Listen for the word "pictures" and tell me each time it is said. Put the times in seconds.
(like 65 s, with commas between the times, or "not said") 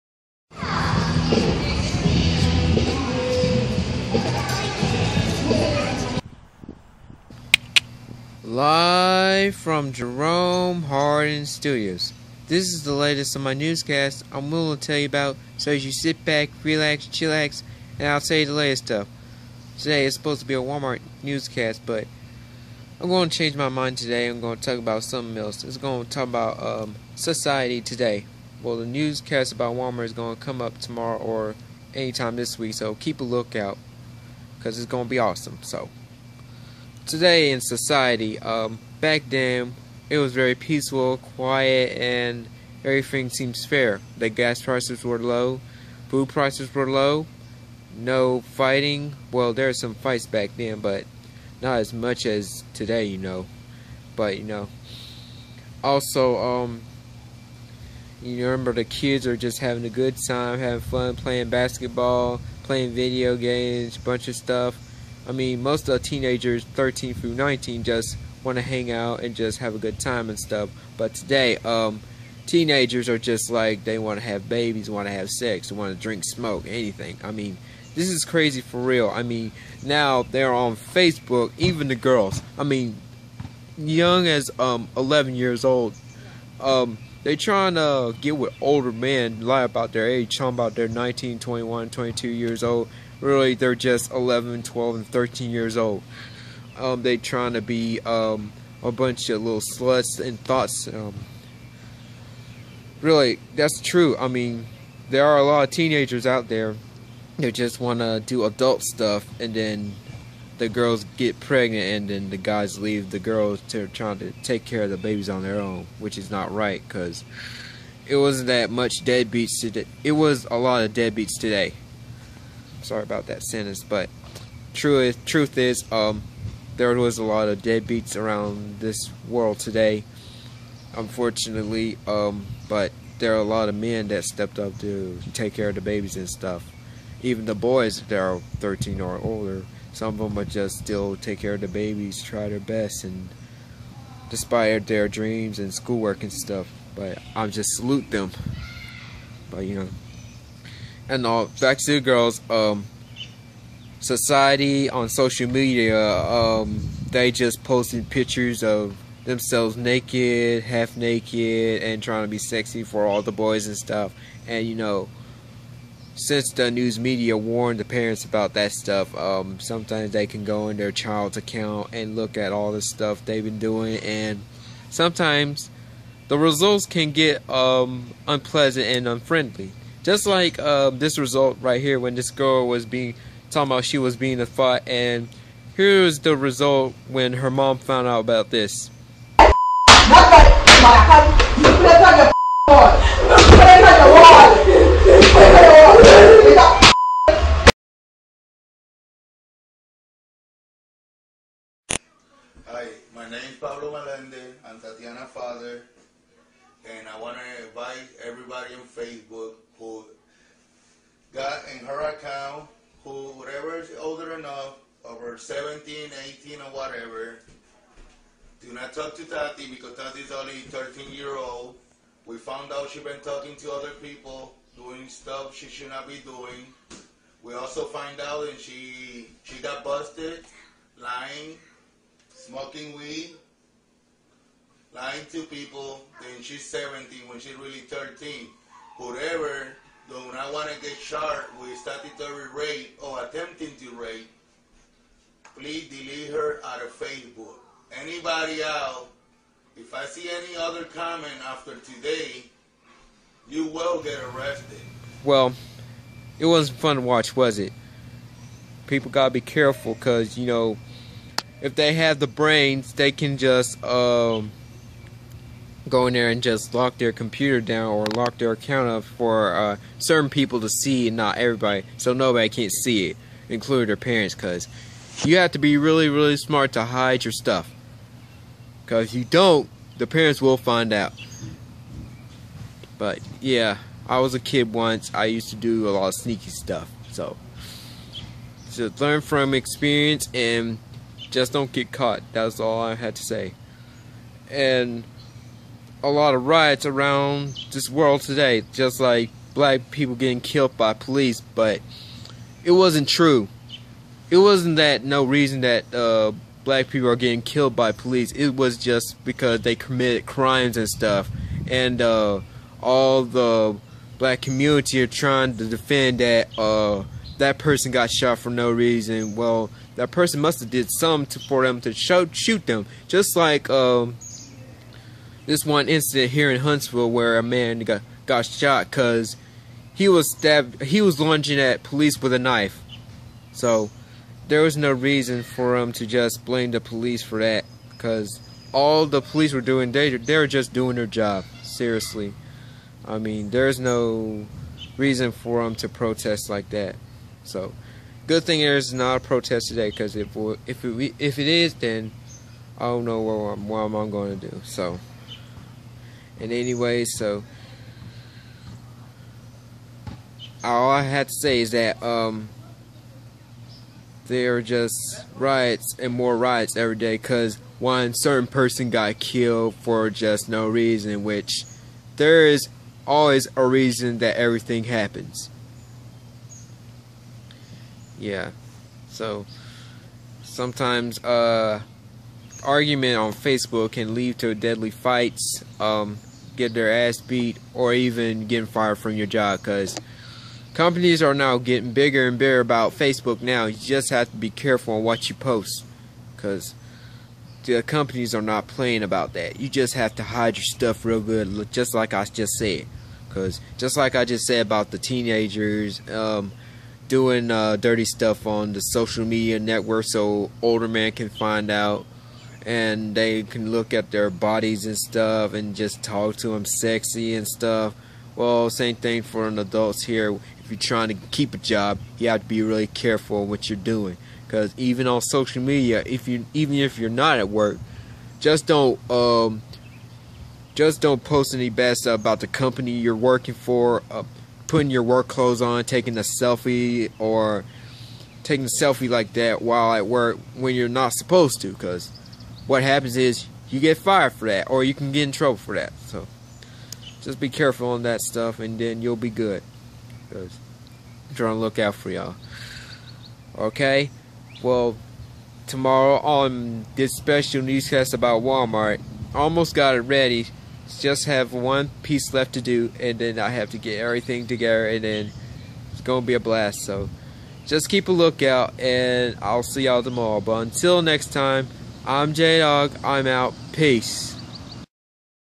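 158 s.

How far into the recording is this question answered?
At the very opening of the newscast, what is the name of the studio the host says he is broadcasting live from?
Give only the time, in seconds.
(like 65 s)
9 s.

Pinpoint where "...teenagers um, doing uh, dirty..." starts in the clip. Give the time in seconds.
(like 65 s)
404 s.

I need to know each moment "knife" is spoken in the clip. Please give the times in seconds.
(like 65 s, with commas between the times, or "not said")
332 s.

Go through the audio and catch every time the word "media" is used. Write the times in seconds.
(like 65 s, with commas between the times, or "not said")
155 s, 166 s, 409 s, 425 s.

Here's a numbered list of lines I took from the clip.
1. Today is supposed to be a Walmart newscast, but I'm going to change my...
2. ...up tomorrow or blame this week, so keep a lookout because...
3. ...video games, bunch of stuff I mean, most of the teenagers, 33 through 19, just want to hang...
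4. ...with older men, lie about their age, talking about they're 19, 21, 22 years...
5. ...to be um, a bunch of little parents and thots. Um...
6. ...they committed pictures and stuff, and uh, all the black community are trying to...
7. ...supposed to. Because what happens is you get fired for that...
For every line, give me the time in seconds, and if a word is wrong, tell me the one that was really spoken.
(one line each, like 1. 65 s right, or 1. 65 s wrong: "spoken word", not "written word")
1. 19 s right
2. 30 s wrong: "anytime", not "blame"
3. 62 s wrong: "13", not "33"
4. 88 s right
5. 97 s wrong: "sluts", not "parents"
6. 309 s wrong: "crimes", not "pictures"
7. 441 s right.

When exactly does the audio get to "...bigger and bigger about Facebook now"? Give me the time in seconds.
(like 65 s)
391 s.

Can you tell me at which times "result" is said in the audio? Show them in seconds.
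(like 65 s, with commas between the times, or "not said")
176 s, 181 s, 186 s.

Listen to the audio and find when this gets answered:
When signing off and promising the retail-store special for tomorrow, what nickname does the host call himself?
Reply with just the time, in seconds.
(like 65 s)
472 s.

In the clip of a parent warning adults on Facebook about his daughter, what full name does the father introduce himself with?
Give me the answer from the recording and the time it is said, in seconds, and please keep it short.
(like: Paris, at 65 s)
Pablo Melendez, at 203 s.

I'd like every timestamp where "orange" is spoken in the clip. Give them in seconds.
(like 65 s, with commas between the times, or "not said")
not said.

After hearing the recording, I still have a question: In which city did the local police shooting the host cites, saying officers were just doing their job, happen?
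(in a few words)
Huntsville.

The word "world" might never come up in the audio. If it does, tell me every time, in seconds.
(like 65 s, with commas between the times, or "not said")
129 s, 297 s.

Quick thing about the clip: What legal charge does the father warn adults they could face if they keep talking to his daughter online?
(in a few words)
Statutory rape.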